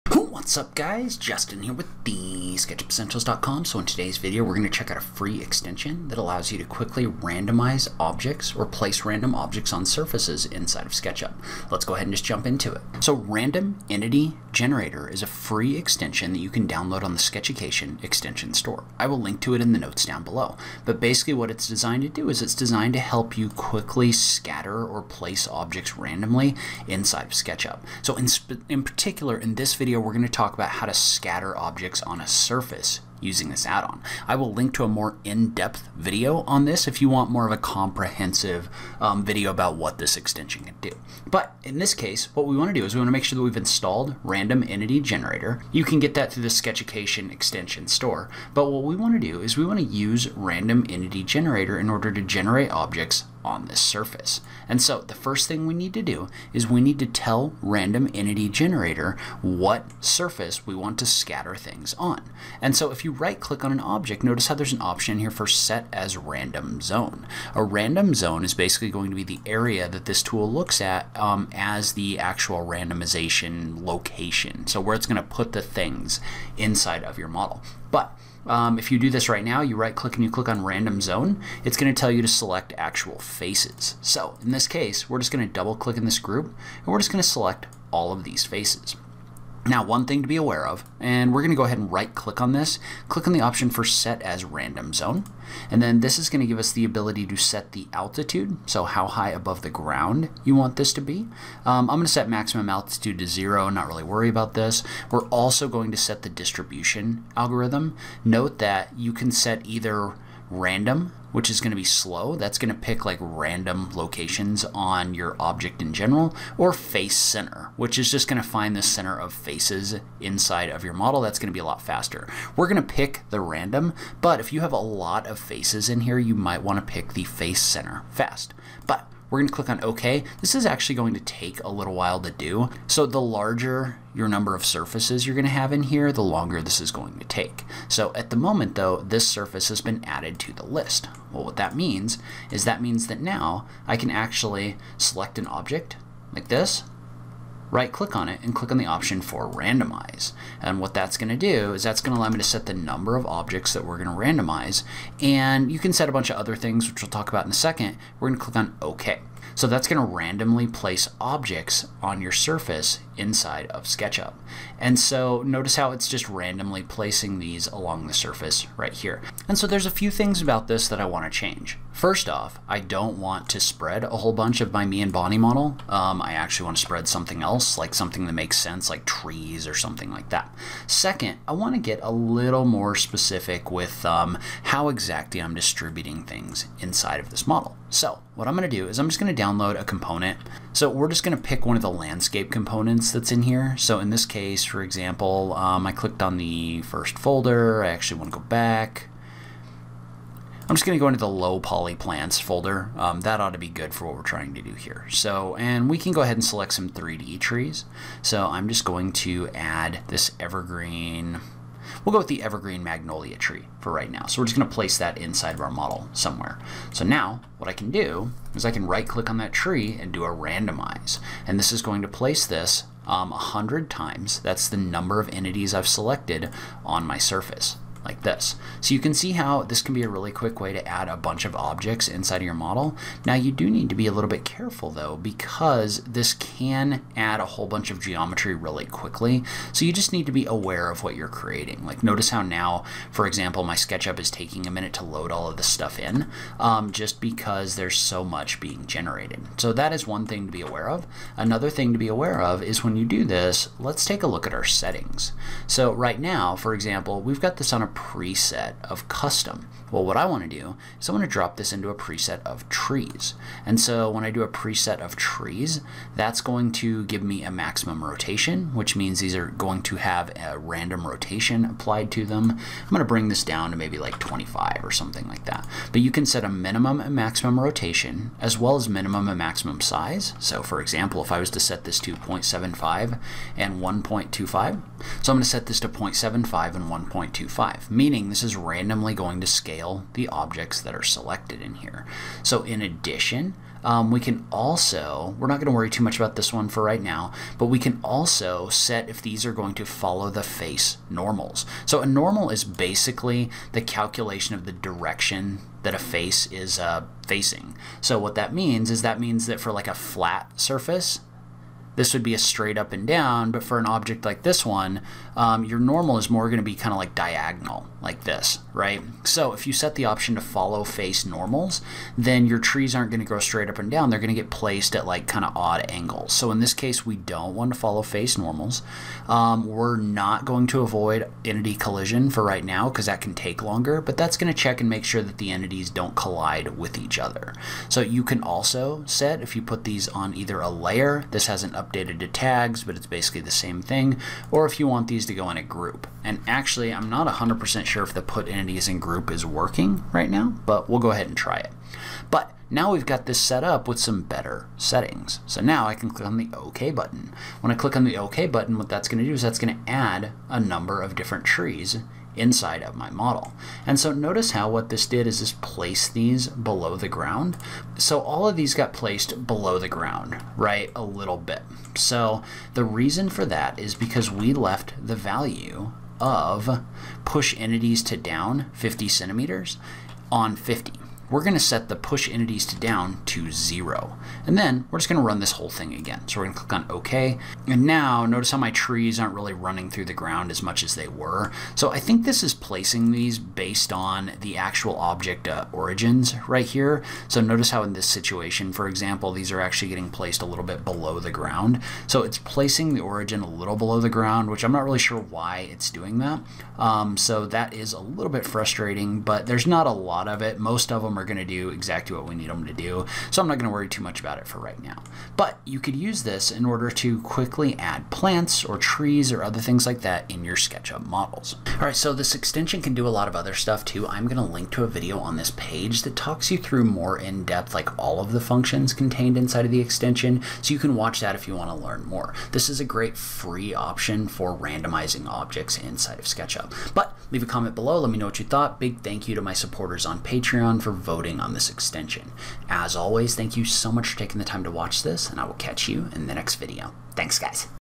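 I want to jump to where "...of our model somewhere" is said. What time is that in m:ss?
3:35.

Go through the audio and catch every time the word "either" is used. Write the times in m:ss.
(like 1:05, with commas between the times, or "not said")
1:49, 5:40.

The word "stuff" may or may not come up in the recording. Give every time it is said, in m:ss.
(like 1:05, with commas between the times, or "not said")
4:05, 7:03.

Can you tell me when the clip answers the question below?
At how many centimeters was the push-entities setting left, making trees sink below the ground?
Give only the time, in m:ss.
6:18.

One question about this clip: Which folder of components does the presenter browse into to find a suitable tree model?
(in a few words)
Low poly plants.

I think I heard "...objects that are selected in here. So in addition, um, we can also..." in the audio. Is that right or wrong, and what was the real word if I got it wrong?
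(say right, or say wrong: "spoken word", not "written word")
right.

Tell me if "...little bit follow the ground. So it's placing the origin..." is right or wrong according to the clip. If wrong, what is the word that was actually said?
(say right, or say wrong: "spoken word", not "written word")
wrong: "below", not "follow".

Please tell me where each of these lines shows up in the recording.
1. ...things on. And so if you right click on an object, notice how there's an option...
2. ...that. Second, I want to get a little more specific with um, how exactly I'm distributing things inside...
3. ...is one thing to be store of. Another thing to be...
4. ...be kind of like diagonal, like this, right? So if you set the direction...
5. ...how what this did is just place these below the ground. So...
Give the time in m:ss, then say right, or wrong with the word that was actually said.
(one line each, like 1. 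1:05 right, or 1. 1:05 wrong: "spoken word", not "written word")
1. 1:01 right
2. 3:00 right
3. 4:09 wrong: "aware", not "store"
4. 5:16 wrong: "option", not "direction"
5. 6:04 right.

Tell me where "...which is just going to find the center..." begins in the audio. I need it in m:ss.
1:57.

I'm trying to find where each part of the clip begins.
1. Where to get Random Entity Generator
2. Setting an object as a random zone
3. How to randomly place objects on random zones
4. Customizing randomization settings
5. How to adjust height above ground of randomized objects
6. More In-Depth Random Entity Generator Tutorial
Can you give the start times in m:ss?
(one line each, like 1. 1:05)
1. 0:12
2. 0:46
3. 2:32
4. 3:41
5. 5:59
6. 7:02.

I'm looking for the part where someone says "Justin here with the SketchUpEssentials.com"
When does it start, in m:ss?
0:01.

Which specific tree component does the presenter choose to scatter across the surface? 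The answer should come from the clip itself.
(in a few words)
Evergreen magnolia tree.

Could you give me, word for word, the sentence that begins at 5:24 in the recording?
They're going to get placed at like kind of odd angles.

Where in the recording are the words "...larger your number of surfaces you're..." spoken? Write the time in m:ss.
2:13.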